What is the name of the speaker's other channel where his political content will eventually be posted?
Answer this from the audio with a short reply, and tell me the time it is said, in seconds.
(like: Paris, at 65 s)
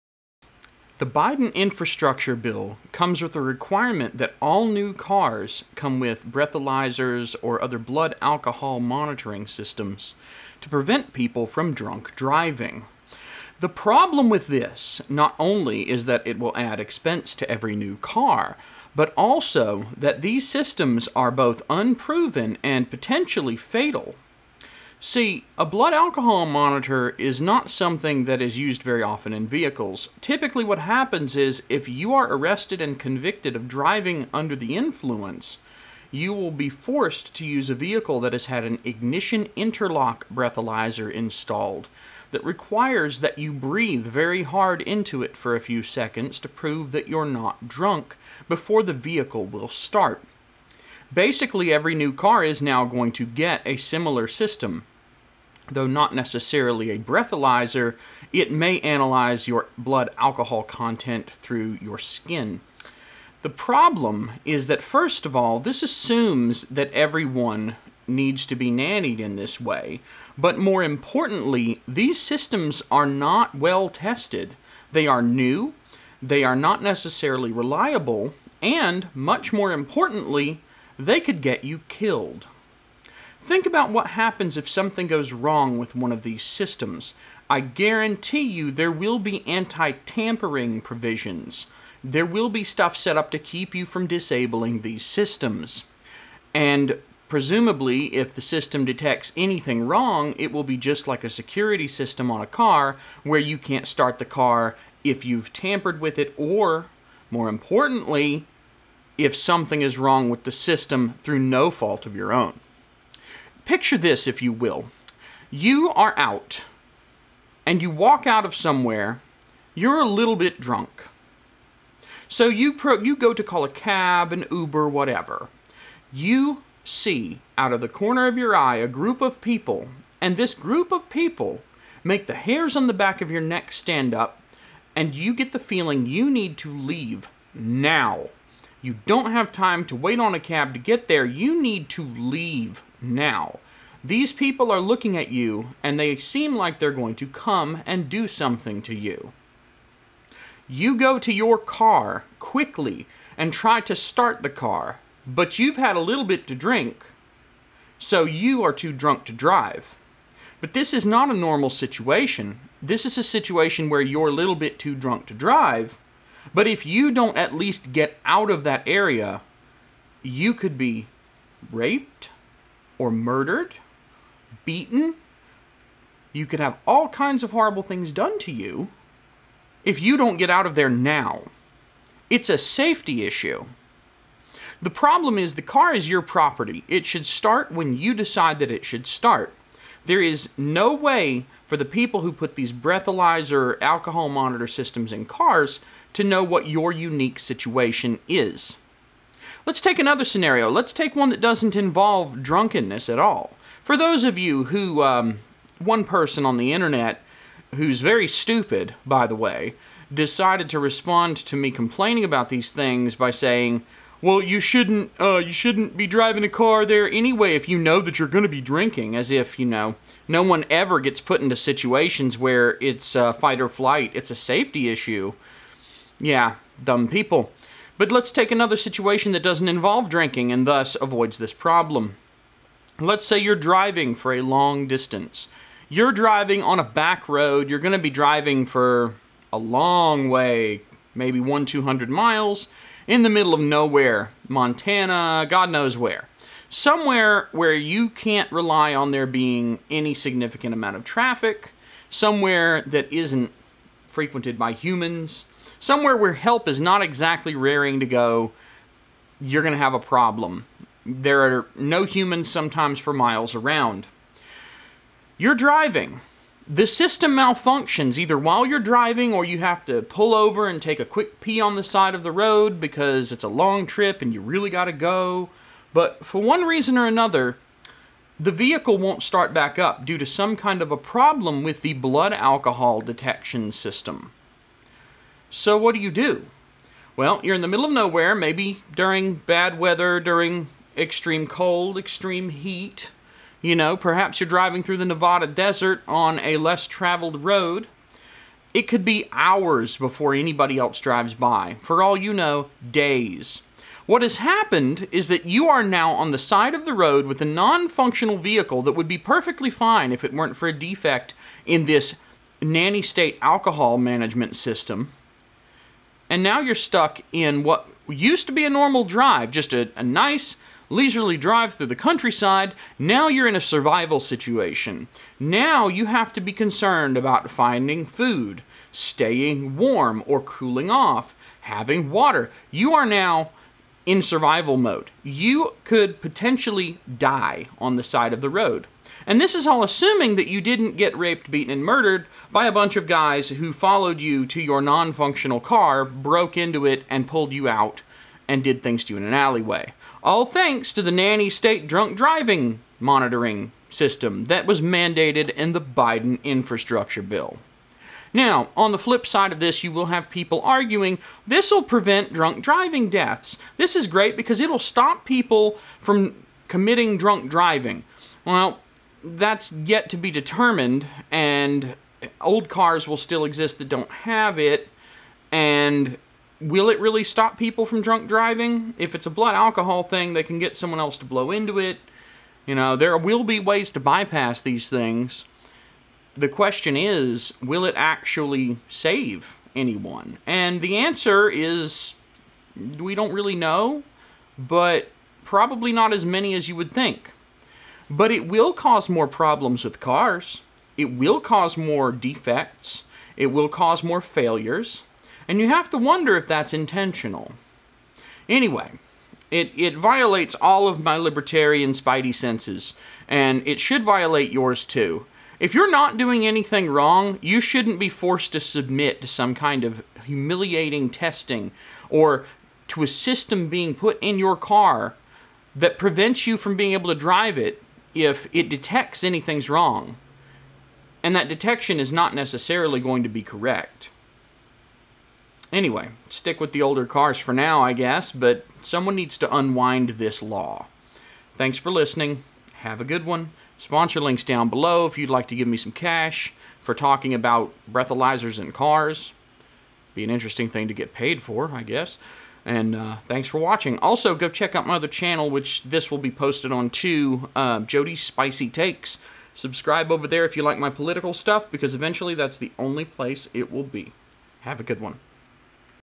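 Jody's Spicy Takes, at 457 s.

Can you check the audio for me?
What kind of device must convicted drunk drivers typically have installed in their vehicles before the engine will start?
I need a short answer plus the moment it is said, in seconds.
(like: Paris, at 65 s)
ignition interlock breathalyzer, at 38 s.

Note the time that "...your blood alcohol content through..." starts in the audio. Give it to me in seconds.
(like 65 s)
59 s.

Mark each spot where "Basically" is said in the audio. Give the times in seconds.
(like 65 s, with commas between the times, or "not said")
51 s.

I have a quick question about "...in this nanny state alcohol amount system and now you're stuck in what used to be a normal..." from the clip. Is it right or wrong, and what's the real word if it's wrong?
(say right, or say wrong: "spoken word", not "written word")
wrong: "management", not "amount".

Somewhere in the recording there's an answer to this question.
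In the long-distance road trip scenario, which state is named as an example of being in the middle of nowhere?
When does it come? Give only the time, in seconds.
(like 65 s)
244 s.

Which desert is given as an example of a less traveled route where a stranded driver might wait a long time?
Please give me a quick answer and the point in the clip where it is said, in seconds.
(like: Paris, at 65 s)
Nevada desert, at 295 s.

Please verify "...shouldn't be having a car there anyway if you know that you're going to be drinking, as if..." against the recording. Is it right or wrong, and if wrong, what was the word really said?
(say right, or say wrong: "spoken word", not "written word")
wrong: "driving", not "having".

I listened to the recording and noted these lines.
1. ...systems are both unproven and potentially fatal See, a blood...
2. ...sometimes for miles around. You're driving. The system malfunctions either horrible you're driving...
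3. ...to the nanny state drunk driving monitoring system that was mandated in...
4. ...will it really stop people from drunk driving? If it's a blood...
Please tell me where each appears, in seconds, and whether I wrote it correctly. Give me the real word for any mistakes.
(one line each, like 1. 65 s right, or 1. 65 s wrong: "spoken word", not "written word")
1. 20 s right
2. 262 s wrong: "while", not "horrible"
3. 350 s right
4. 376 s right.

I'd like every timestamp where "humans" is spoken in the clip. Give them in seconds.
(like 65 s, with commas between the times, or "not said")
254 s, 262 s.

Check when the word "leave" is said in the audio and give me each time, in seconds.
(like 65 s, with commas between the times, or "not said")
136 s, 142 s.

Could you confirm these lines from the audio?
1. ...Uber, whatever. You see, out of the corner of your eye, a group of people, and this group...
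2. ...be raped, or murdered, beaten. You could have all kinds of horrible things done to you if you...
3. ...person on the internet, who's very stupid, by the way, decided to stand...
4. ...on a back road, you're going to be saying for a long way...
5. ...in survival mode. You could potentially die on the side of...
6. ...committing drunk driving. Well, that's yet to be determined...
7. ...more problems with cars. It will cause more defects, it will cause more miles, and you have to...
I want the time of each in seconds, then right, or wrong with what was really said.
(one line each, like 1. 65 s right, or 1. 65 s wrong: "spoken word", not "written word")
1. 124 s right
2. 170 s right
3. 206 s wrong: "respond", not "stand"
4. 236 s wrong: "driving", not "saying"
5. 334 s right
6. 366 s right
7. 399 s wrong: "failures", not "miles".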